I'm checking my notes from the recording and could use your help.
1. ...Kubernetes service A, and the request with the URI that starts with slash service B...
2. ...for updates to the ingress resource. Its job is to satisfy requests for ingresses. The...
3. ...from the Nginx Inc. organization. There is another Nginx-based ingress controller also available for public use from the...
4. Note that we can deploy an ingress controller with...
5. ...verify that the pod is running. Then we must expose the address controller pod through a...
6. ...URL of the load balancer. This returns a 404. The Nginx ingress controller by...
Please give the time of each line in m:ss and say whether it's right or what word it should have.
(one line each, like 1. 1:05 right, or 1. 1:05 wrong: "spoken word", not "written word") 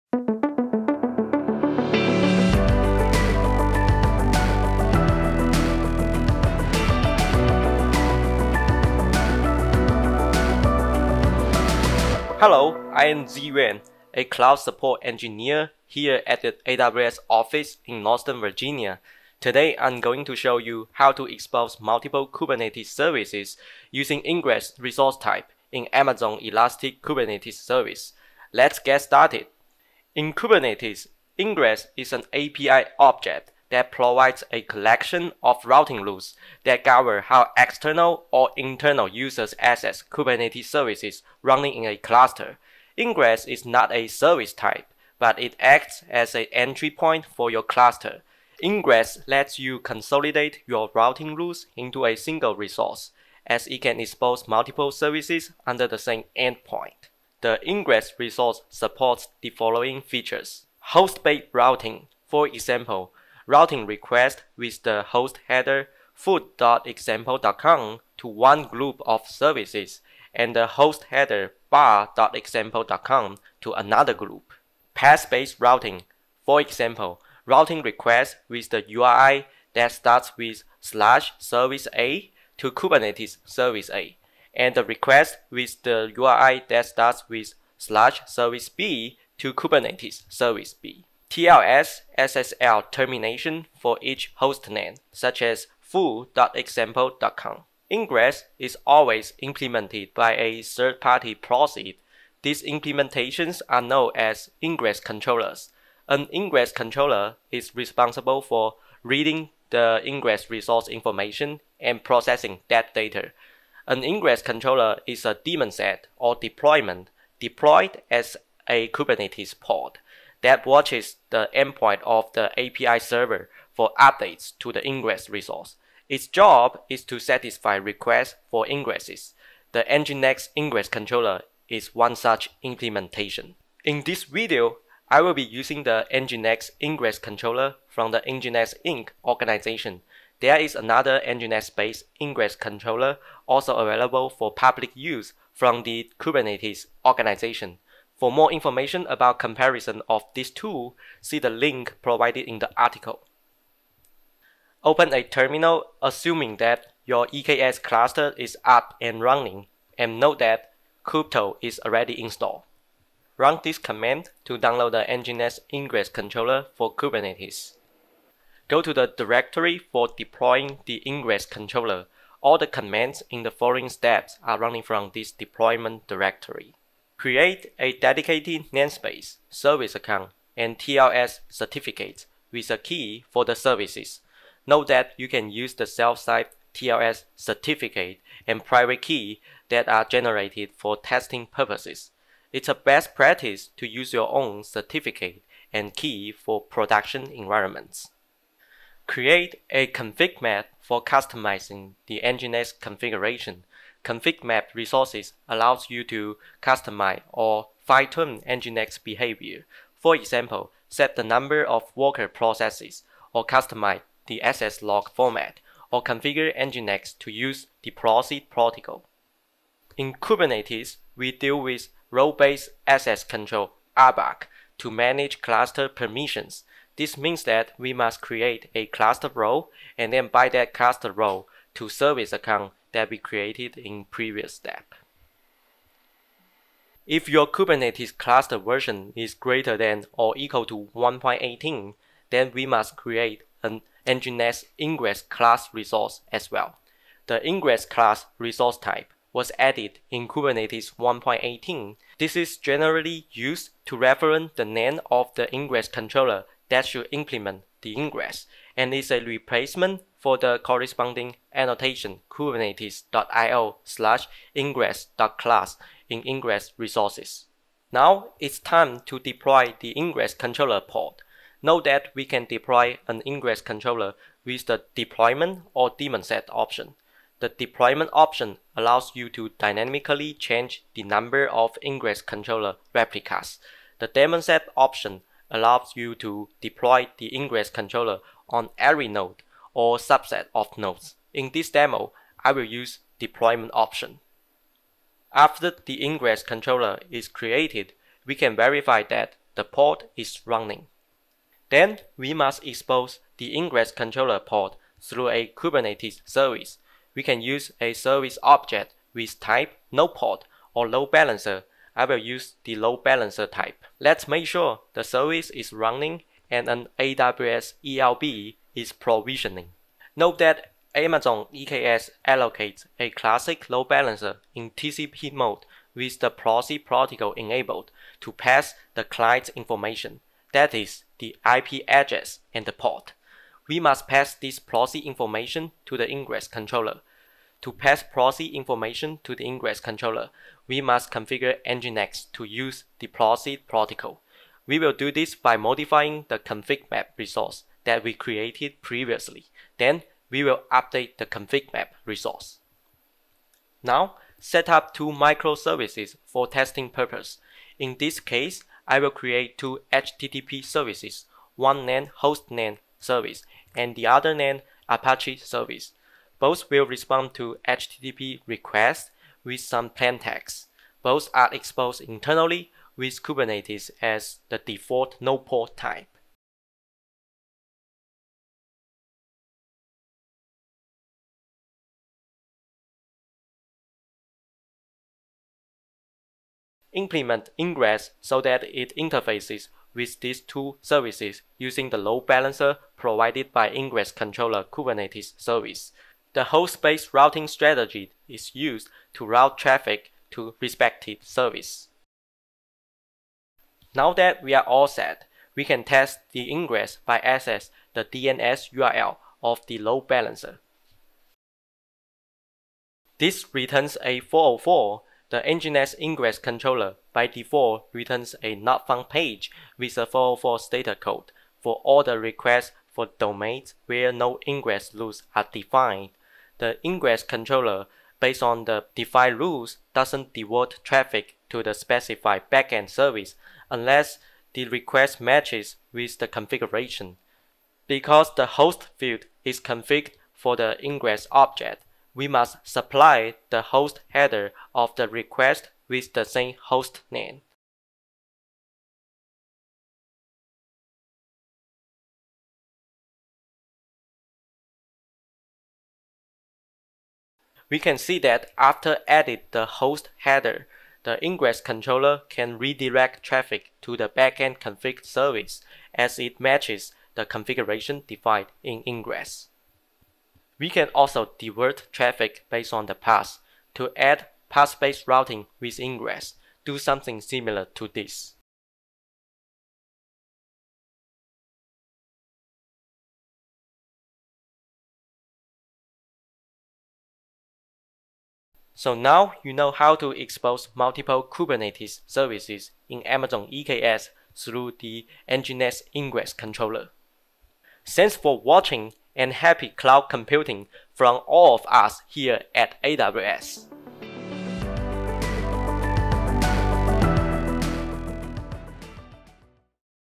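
1. 1:22 right
2. 2:03 right
3. 2:17 right
4. 4:31 right
5. 4:58 wrong: "ingress", not "address"
6. 6:48 right.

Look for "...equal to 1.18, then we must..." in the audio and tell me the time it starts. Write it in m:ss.
4:00.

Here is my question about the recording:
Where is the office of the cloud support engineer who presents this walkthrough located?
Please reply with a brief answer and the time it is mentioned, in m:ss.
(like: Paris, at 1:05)
Northern Virginia, at 0:18.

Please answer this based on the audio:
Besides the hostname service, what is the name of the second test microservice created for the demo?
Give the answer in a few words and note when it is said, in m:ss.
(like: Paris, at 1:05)
Apache service, at 6:04.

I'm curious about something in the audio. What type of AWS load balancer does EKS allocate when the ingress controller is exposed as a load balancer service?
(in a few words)
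classic load balancer.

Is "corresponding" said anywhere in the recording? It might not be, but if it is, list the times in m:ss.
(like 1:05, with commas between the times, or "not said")
4:20.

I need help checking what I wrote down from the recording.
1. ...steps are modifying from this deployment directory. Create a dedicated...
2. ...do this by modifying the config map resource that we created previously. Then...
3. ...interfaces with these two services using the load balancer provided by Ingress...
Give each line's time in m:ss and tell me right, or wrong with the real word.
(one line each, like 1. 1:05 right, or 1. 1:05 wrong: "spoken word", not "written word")
1. 2:53 wrong: "running", not "modifying"
2. 5:44 right
3. 6:28 right.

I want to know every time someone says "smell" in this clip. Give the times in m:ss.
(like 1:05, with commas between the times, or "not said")
not said.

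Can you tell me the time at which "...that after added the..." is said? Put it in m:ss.
7:38.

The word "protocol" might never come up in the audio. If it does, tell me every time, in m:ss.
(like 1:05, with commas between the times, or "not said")
3:38, 5:26, 5:43.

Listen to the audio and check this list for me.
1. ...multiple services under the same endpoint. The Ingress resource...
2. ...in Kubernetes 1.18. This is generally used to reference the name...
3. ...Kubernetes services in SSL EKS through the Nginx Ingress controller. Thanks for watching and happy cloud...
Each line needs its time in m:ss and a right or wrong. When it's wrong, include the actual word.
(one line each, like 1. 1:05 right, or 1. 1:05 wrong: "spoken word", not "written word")
1. 0:54 right
2. 4:10 right
3. 8:11 wrong: "Amazon", not "SSL".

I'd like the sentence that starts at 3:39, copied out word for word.
In Kubernetes, we deal with role-based access control RBAC to manage cluster permissions.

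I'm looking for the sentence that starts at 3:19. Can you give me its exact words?
Create a config map for customizing the Nginx configuration Config map resources allows you to customize or fine-tune Nginx behavior.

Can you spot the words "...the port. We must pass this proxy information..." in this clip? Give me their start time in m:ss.
5:32.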